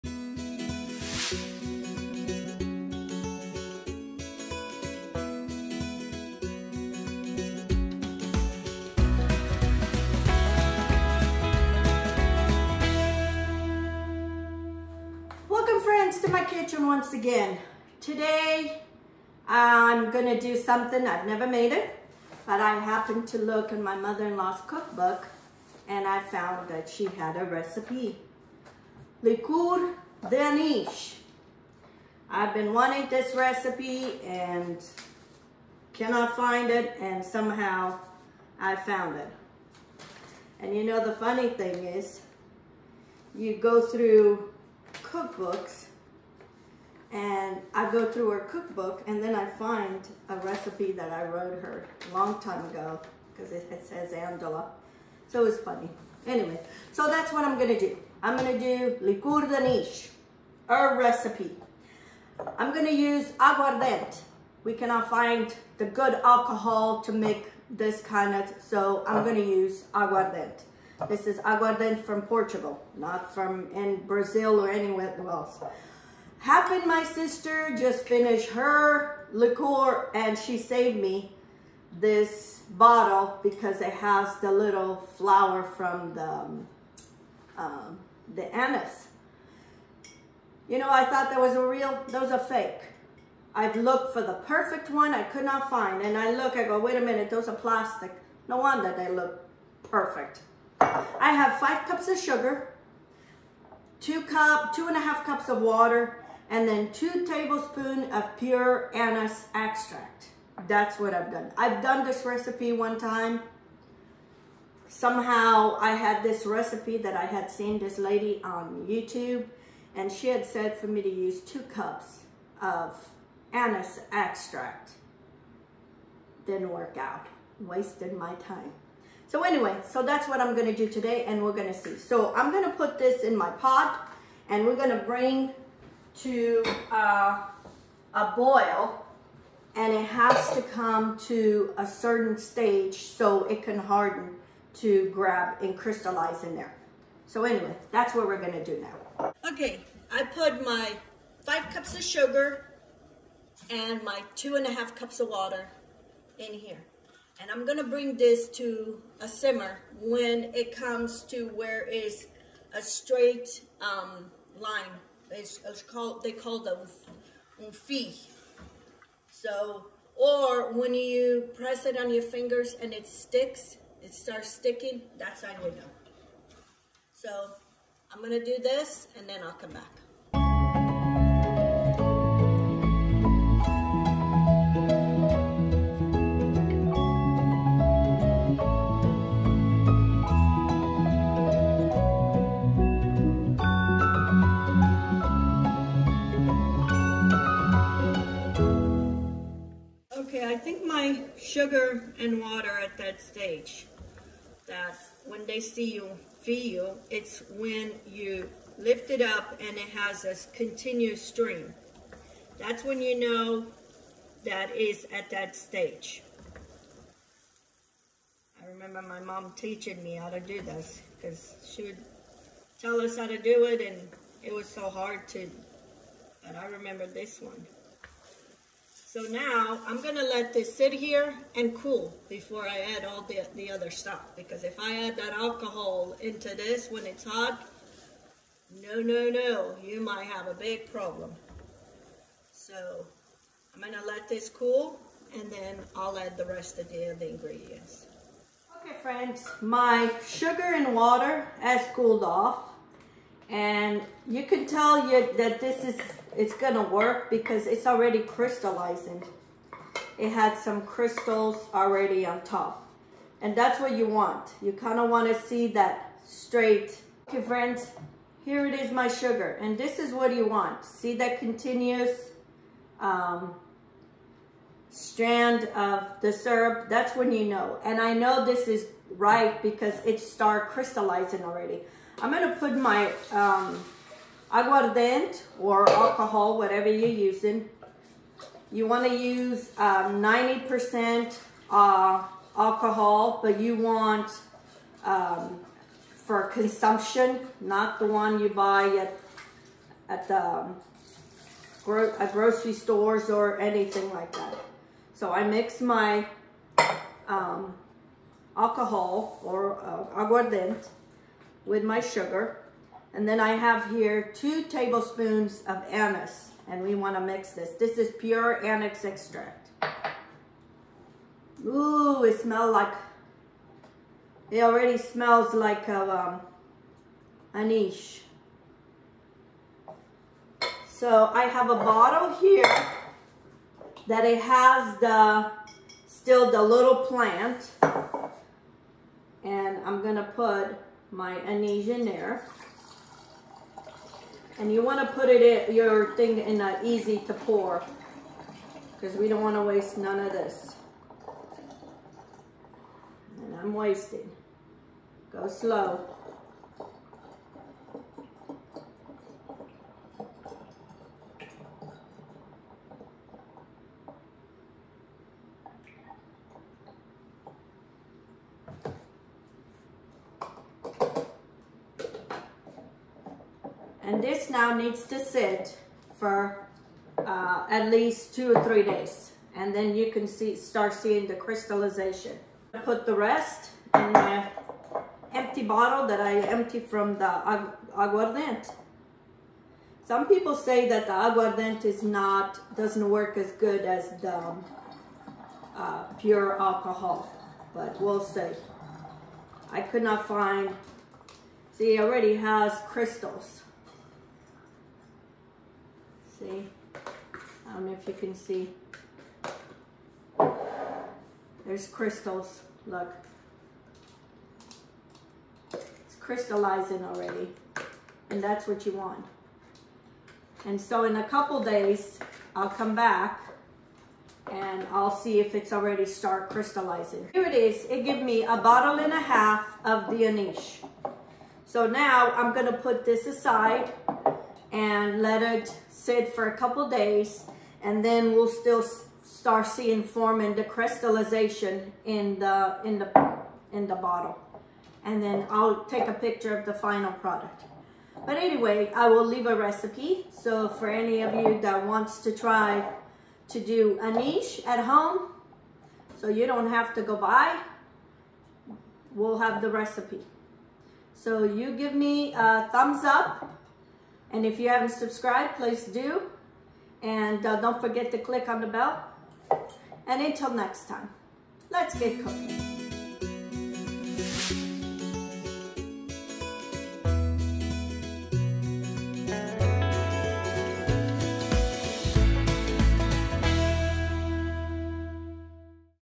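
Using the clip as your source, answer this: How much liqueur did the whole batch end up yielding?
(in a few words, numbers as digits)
A bottle and a half.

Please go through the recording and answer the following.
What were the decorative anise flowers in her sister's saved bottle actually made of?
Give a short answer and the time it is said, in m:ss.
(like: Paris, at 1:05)
Plastic, at 1:37.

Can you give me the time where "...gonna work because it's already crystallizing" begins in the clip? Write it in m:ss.
4:16.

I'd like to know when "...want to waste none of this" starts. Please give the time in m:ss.
5:49.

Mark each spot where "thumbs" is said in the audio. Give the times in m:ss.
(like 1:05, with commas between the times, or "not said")
7:42.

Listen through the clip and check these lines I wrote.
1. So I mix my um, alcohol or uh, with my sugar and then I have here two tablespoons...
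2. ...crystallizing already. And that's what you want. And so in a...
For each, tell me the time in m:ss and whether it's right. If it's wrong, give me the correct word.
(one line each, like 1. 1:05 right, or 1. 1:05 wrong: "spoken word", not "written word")
1. 5:05 right
2. 6:56 right.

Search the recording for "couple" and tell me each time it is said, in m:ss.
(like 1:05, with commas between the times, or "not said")
7:01, 7:16.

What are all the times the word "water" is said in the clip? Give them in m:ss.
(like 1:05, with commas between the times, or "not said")
1:45, 2:35, 3:22, 4:10.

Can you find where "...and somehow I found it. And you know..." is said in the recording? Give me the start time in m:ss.
0:36.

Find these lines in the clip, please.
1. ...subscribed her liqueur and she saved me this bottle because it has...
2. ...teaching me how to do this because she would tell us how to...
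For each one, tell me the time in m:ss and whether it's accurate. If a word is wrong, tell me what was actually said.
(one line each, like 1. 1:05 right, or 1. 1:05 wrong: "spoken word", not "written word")
1. 1:18 wrong: "finished", not "subscribed"
2. 3:39 right.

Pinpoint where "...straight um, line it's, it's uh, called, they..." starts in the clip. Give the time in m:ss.
2:42.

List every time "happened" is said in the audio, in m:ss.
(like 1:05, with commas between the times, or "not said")
0:22, 1:16.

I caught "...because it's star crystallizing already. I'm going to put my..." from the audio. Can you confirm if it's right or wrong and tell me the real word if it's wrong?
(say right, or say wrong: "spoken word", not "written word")
right.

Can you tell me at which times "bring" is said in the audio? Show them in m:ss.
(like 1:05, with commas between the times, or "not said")
2:15, 2:37.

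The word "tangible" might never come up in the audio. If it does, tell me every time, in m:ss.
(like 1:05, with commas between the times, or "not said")
not said.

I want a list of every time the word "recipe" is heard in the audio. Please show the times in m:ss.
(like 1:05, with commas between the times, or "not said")
0:27, 0:33, 0:50, 1:00, 1:52, 1:56, 7:29, 7:39.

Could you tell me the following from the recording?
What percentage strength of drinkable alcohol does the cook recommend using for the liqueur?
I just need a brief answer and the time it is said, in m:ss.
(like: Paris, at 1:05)
90%, at 4:49.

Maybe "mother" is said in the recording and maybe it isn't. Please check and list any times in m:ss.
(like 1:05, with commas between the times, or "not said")
0:23.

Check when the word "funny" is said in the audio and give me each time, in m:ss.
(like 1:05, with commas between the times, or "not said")
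0:41, 0:55.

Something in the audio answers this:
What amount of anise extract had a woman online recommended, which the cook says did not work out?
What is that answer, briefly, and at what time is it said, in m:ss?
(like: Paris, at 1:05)
2 cups, at 2:01.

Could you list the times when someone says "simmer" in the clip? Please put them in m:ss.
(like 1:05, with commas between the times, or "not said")
2:39.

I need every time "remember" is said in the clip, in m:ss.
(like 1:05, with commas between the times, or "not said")
3:38, 3:46.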